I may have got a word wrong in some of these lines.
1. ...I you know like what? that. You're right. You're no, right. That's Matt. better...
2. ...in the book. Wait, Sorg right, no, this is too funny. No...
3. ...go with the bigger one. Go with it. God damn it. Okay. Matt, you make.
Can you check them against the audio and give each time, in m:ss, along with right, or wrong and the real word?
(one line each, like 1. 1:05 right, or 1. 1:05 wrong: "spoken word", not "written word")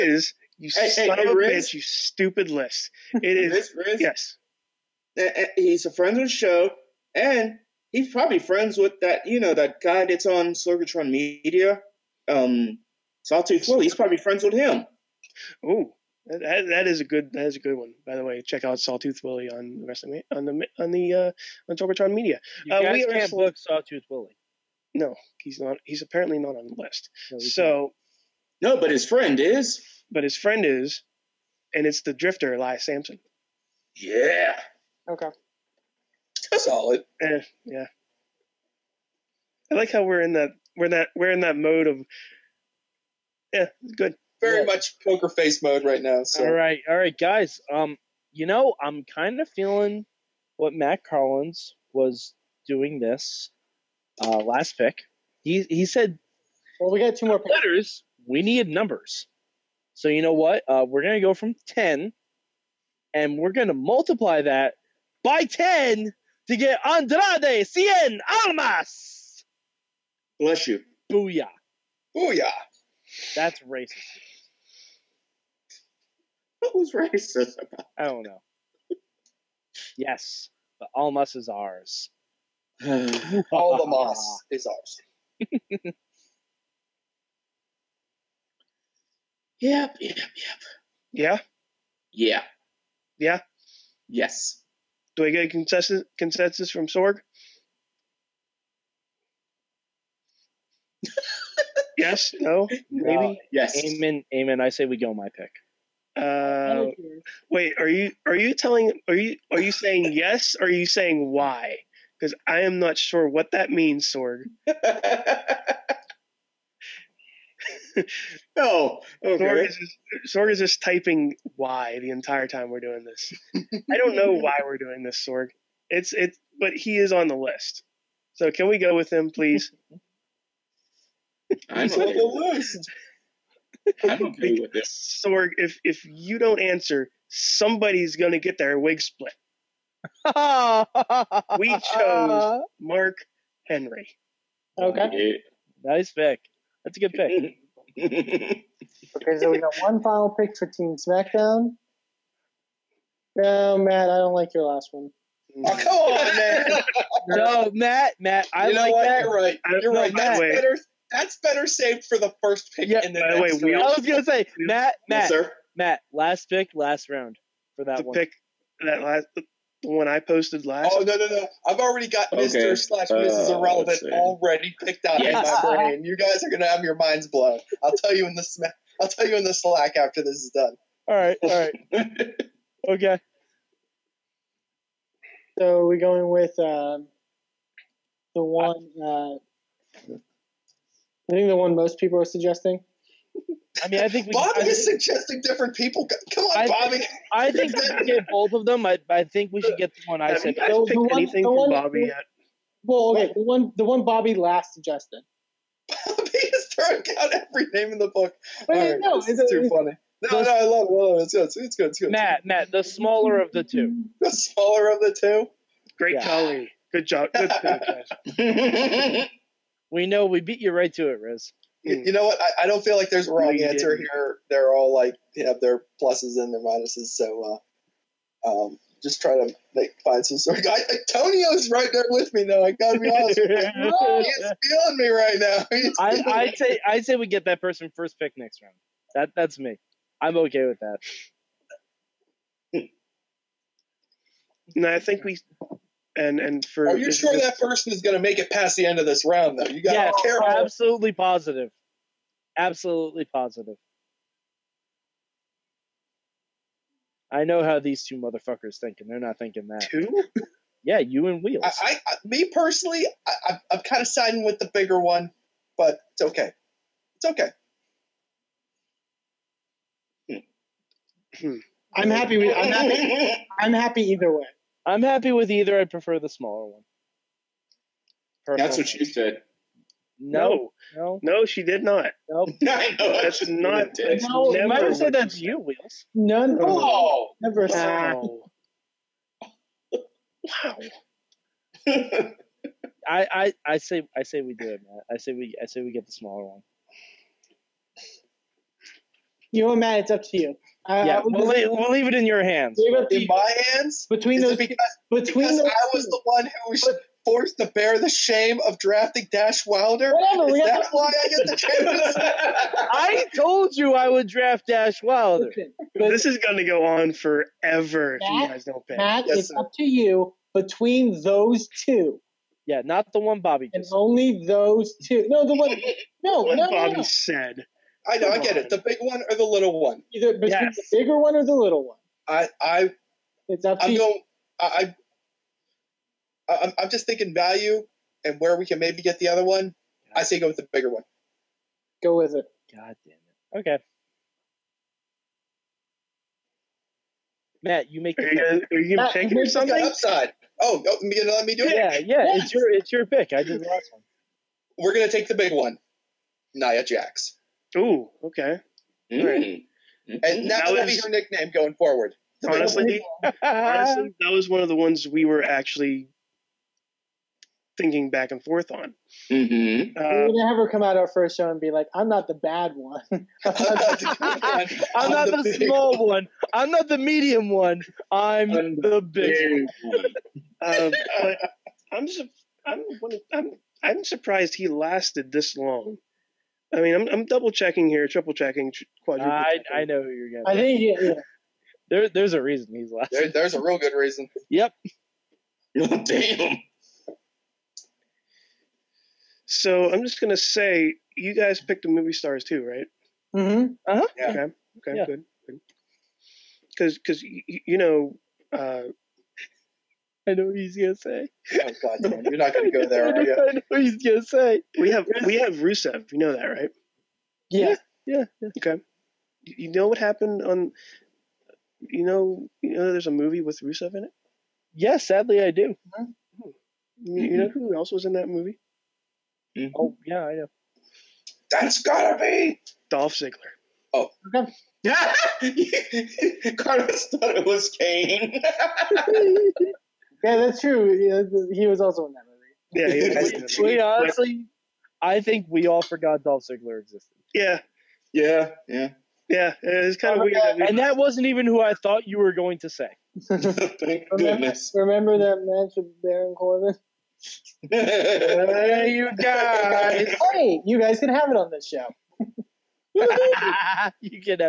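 1. 2:38 right
2. 3:27 wrong: "All", not "Sorg"
3. 5:40 right.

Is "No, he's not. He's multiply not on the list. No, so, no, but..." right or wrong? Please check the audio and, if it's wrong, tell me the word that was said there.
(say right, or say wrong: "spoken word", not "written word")
wrong: "apparently", not "multiply".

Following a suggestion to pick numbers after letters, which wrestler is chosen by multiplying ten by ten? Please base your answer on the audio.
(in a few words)
Andrade Cien Almas.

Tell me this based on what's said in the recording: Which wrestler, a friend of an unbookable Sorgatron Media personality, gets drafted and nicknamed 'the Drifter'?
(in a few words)
Elias Samson.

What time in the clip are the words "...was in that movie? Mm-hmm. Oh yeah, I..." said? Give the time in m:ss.
7:07.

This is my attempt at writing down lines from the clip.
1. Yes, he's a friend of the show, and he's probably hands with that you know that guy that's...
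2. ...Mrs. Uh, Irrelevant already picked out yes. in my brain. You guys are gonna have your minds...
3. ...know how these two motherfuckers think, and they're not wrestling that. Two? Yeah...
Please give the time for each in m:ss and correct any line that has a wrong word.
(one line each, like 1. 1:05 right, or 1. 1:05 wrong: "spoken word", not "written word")
1. 0:04 wrong: "friends", not "hands"
2. 2:53 right
3. 4:17 wrong: "thinking", not "wrestling".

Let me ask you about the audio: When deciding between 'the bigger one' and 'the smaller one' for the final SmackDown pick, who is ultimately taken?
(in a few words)
Nia Jax.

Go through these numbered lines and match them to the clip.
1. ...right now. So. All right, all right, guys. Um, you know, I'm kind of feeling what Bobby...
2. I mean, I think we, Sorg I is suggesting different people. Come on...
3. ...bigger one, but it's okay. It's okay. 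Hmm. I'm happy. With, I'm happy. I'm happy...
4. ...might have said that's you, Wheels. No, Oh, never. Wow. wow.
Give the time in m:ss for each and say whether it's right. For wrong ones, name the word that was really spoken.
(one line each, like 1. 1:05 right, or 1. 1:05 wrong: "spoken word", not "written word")
1. 0:45 wrong: "Matt", not "Bobby"
2. 3:13 wrong: "Bobby", not "Sorg"
3. 4:24 right
4. 4:44 right.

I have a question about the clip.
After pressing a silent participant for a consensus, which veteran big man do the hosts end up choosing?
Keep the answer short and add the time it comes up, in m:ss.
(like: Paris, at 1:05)
Mark Henry, at 2:22.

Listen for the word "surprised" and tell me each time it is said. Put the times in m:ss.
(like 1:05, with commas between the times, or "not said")
6:24.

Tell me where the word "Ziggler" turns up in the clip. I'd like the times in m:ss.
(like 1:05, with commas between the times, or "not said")
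7:13, 7:26.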